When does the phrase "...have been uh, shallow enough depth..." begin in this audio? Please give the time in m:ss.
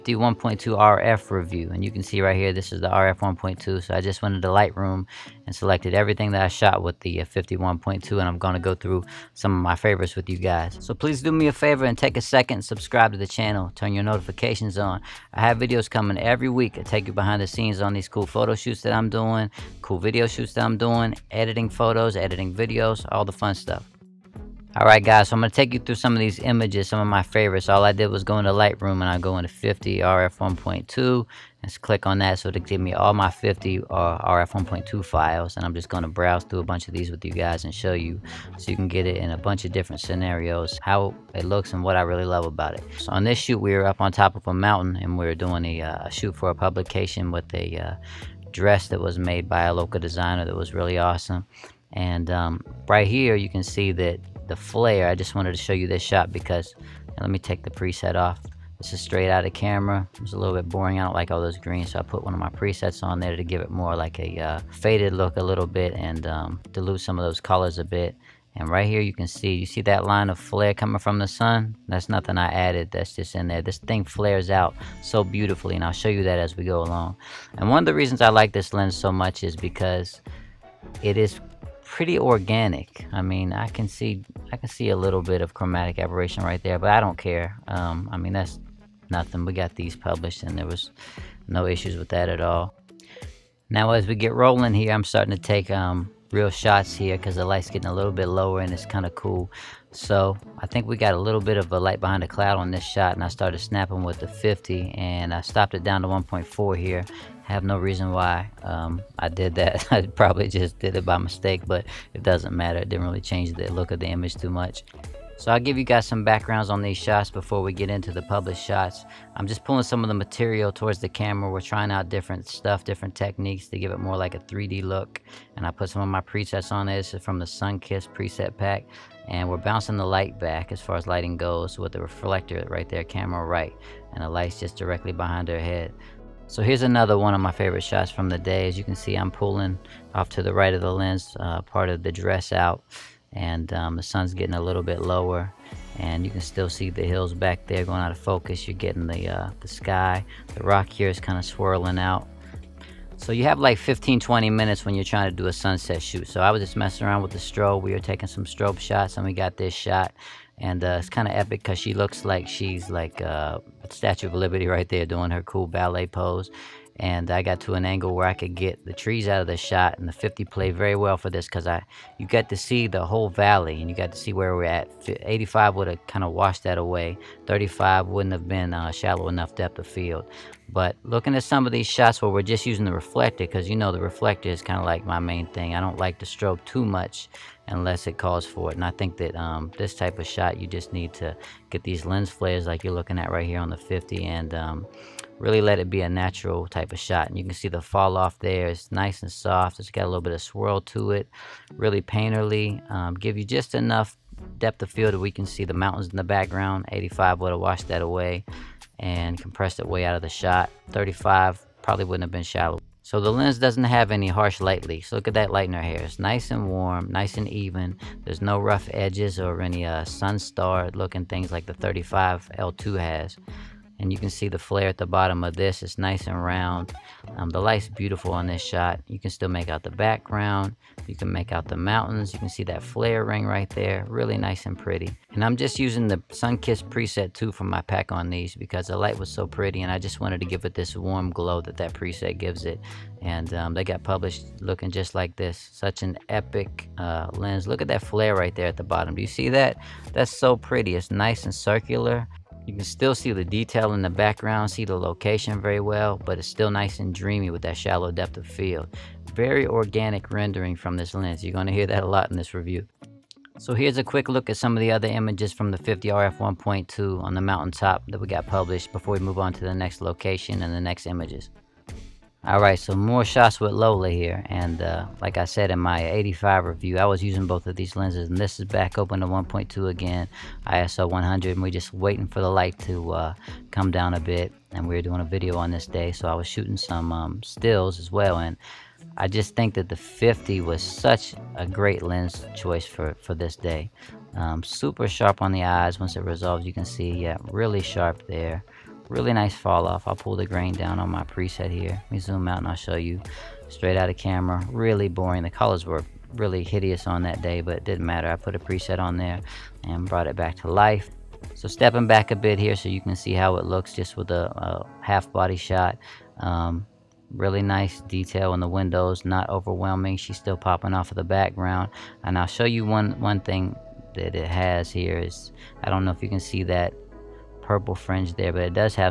2:58.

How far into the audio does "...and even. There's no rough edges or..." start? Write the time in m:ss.
3:37.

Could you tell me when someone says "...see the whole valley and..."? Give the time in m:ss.
2:52.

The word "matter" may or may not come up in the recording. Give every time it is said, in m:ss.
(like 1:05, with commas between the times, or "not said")
1:52, 5:08.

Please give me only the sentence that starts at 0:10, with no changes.
So please do me a favor and take a second, subscribe to the channel, turn your notifications on.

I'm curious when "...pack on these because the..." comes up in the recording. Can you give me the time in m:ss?
3:57.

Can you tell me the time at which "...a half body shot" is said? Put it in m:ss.
5:14.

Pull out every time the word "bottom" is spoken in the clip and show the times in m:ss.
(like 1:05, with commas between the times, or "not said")
3:45, 4:08.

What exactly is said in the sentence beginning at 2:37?
We were taking some strobe shots and we got this shot.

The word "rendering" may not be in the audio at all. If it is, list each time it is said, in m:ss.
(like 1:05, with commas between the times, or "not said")
4:20.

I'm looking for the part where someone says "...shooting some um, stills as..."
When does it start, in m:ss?
4:46.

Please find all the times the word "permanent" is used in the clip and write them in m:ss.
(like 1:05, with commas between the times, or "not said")
not said.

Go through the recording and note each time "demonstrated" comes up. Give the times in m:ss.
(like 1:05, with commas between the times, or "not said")
not said.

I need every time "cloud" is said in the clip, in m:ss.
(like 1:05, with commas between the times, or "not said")
1:42.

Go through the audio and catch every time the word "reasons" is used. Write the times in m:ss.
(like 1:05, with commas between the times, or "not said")
1:17, 1:47.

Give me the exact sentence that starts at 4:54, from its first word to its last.
Um, super sharp on the eyes once it resolves, you can see, yeah, really sharp there.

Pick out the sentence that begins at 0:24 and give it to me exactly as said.
Alright guys, so I'm going to take you through some of these images, some of my favorites.